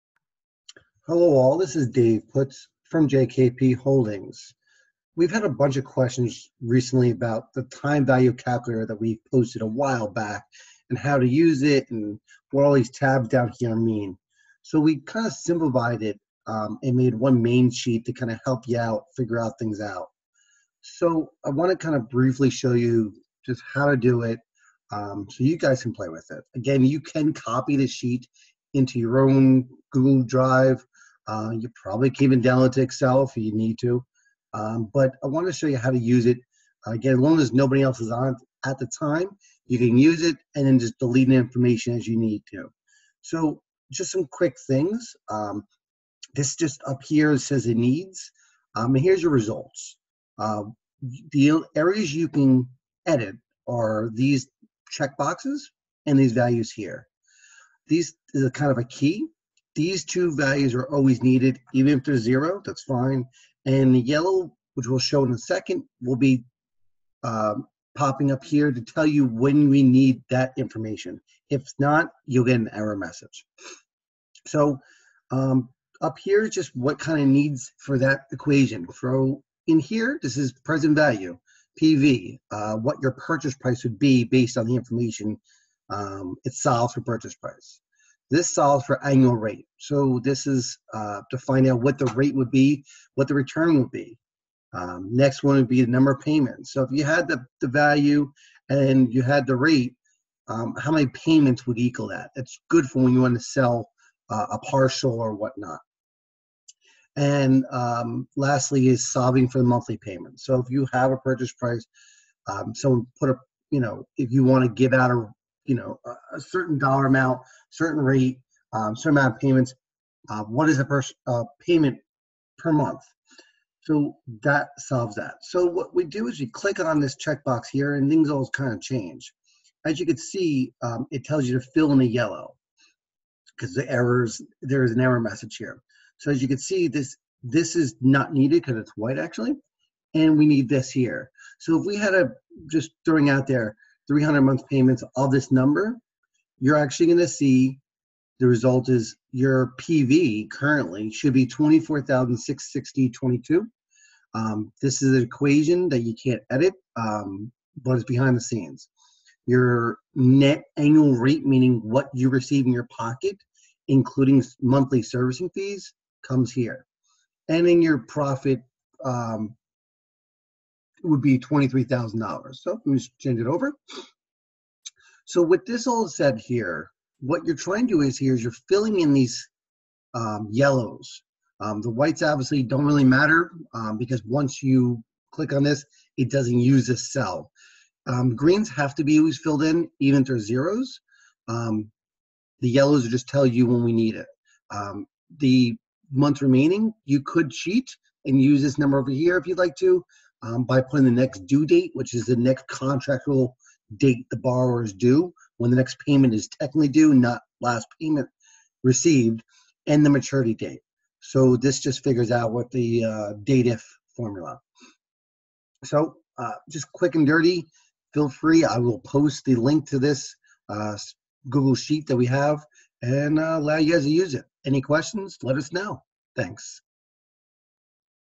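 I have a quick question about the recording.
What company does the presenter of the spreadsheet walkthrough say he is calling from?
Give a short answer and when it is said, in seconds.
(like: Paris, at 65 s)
JKP Holdings, at 3 s.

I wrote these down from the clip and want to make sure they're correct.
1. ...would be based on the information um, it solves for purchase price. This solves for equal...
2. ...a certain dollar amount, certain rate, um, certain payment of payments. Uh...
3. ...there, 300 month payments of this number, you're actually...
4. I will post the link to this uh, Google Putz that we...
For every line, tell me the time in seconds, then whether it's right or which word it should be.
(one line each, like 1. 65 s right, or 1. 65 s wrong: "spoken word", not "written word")
1. 83 s wrong: "annual", not "equal"
2. 116 s wrong: "amount", not "payment"
3. 143 s right
4. 218 s wrong: "Sheet", not "Putz".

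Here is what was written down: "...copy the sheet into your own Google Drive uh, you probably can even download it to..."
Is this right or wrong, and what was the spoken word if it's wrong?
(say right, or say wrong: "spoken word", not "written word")
right.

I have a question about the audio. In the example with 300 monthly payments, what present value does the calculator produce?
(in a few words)
24,660.22.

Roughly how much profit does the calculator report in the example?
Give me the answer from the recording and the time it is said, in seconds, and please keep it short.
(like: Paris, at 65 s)
$23,000, at 171 s.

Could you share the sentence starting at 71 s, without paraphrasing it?
If not, you'll get an error message.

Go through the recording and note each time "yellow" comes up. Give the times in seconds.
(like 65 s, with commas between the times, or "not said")
64 s, 132 s, 180 s, 192 s.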